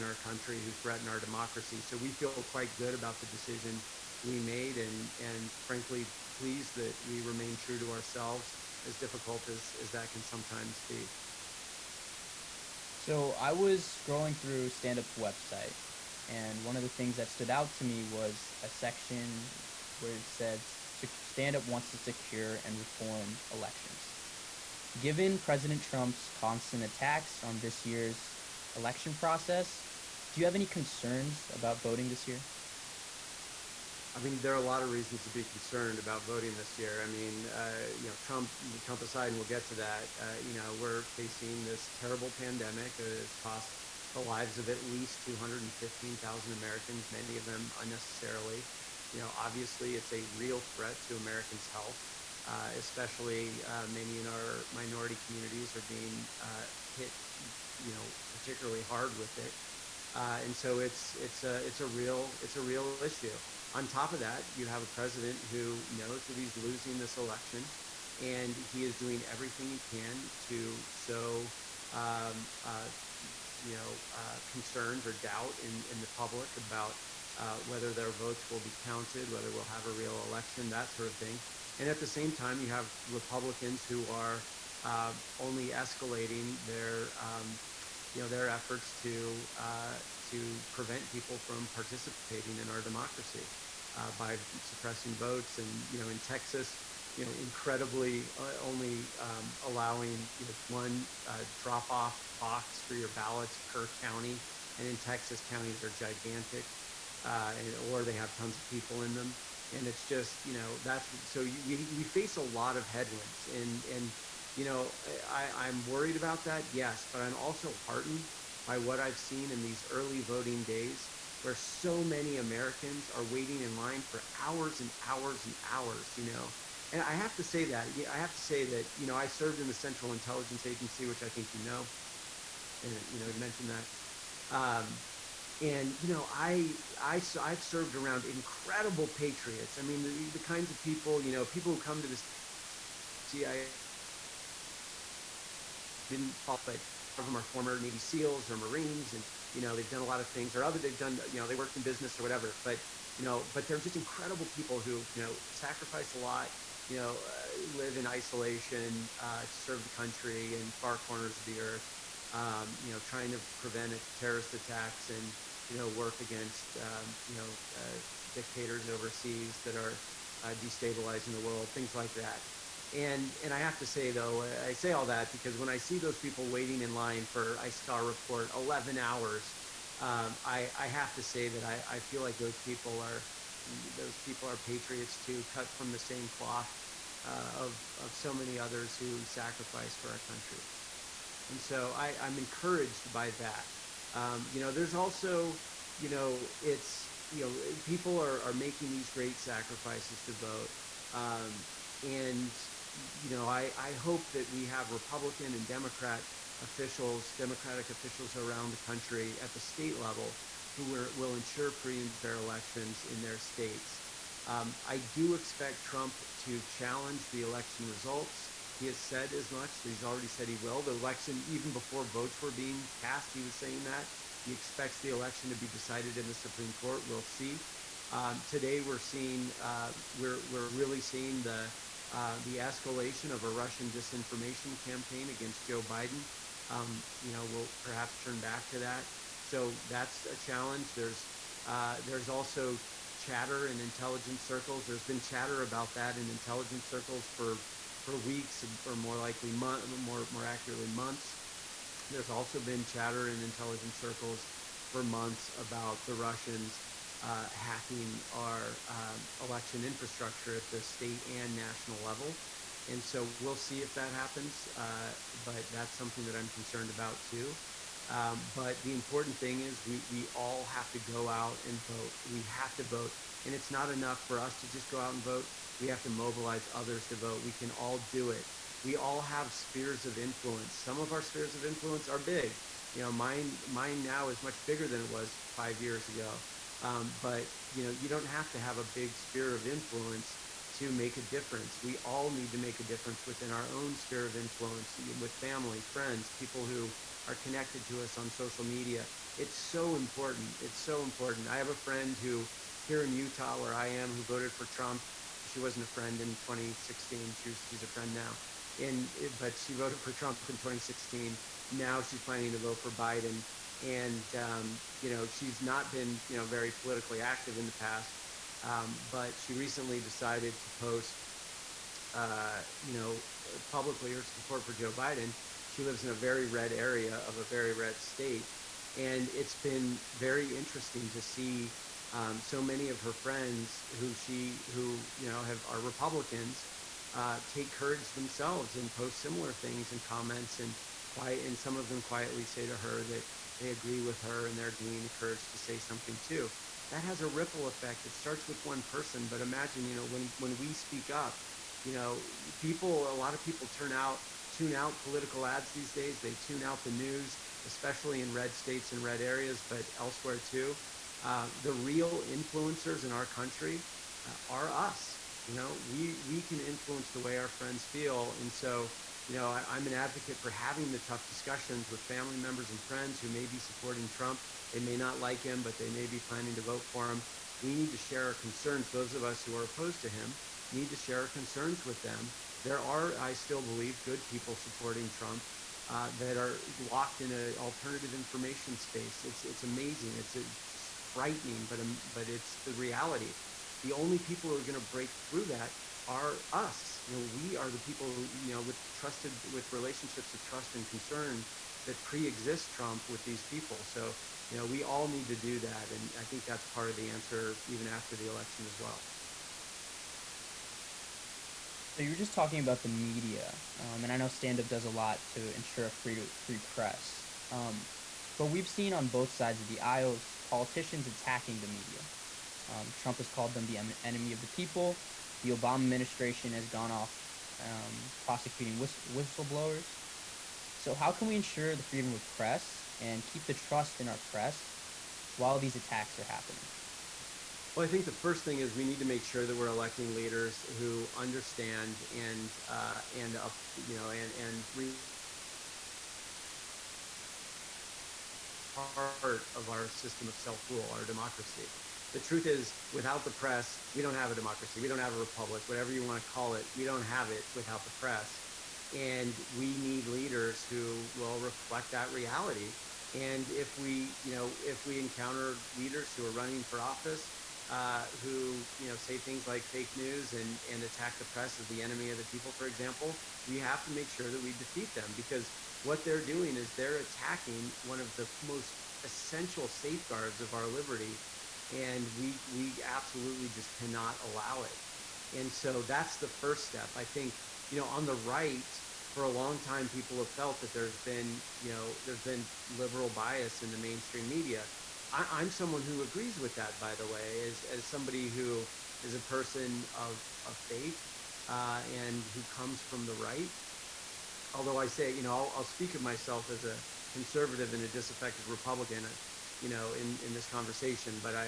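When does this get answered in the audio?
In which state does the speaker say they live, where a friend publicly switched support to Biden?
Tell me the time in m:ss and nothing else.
5:03.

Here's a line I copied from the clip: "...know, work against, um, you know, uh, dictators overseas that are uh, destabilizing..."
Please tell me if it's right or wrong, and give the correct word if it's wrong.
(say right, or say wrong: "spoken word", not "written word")
right.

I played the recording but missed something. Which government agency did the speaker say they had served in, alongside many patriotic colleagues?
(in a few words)
Central Intelligence Agency.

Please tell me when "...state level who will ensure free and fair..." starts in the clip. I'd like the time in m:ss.
3:29.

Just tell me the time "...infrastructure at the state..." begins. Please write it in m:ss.
4:19.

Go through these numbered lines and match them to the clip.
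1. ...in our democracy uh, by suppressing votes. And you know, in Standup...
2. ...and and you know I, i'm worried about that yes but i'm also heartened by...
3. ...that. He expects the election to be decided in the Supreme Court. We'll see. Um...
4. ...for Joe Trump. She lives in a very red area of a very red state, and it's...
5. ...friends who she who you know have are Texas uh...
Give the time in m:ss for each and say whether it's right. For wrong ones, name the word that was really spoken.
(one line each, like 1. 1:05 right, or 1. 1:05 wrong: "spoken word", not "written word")
1. 1:32 wrong: "Texas", not "Standup"
2. 1:53 right
3. 3:43 right
4. 5:24 wrong: "Biden", not "Trump"
5. 5:33 wrong: "Republicans", not "Texas".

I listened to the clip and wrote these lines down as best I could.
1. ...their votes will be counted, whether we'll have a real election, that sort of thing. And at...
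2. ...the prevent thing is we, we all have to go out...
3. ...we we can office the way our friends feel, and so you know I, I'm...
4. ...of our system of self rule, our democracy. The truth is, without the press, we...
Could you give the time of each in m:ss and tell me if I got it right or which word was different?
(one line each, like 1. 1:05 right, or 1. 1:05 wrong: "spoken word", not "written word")
1. 1:17 right
2. 4:28 wrong: "important", not "prevent"
3. 6:05 wrong: "influence", not "office"
4. 7:29 right.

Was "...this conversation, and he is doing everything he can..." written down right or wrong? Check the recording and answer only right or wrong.
wrong.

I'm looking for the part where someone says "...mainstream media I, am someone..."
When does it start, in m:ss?
8:13.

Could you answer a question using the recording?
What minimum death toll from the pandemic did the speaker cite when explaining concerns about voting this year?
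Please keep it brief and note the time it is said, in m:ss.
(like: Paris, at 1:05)
215,000, at 0:45.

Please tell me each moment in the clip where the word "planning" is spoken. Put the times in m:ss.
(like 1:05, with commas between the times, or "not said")
5:12, 6:16.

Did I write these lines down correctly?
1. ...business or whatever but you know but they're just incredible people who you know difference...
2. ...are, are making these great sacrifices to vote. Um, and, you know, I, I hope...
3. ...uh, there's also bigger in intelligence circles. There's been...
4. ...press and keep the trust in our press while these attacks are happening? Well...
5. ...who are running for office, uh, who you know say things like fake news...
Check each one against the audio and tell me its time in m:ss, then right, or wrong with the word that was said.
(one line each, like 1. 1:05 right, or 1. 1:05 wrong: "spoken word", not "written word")
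1. 2:31 wrong: "sacrifice", not "difference"
2. 3:18 right
3. 4:01 wrong: "chatter", not "bigger"
4. 7:12 right
5. 7:46 right.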